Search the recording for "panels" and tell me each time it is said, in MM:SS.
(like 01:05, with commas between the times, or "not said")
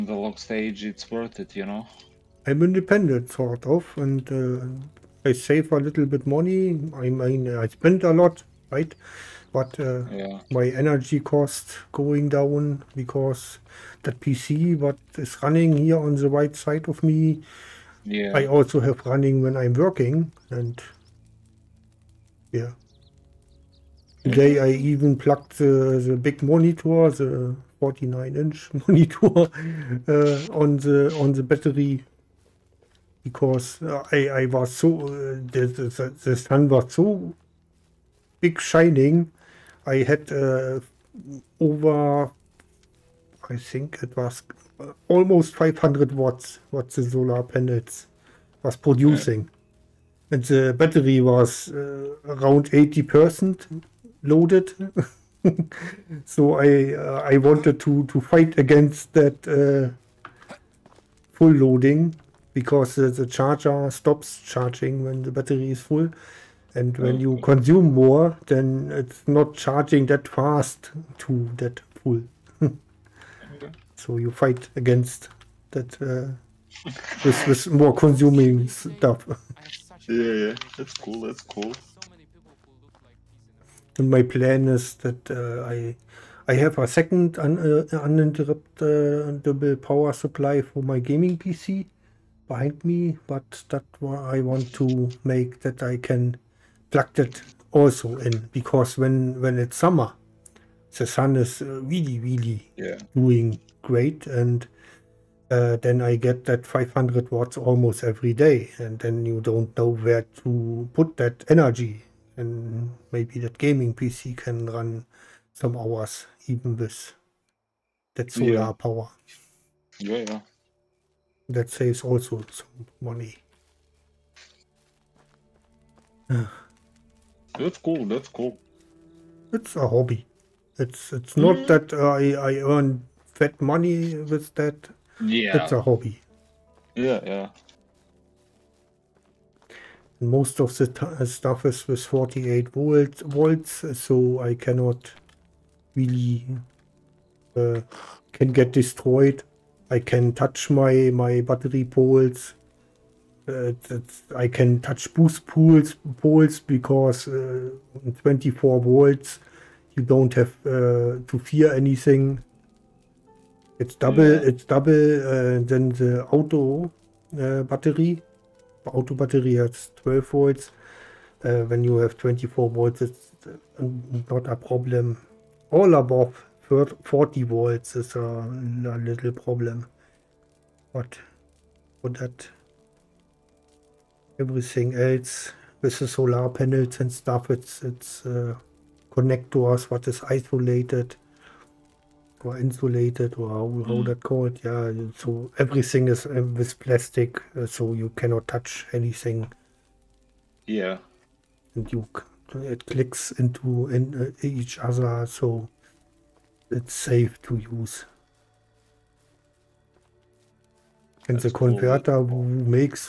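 00:47, 03:06.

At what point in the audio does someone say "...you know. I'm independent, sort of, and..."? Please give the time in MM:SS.
00:01.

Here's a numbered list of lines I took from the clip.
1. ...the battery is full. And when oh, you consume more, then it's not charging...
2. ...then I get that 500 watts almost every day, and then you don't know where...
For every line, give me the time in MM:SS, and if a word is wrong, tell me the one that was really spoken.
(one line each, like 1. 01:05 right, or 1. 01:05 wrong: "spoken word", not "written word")
1. 01:05 right
2. 01:45 right.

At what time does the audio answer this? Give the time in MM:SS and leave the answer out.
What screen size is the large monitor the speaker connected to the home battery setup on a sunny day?
00:27.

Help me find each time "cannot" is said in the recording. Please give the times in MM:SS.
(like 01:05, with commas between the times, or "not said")
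02:24, 03:18.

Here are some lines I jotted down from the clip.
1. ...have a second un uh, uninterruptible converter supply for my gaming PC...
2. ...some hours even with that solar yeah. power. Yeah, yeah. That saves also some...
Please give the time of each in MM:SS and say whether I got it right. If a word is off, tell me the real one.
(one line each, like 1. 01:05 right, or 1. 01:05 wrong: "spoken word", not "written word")
1. 01:26 wrong: "power", not "converter"
2. 01:55 right.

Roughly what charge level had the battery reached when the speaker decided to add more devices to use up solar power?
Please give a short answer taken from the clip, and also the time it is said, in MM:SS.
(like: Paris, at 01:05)
80%, at 00:52.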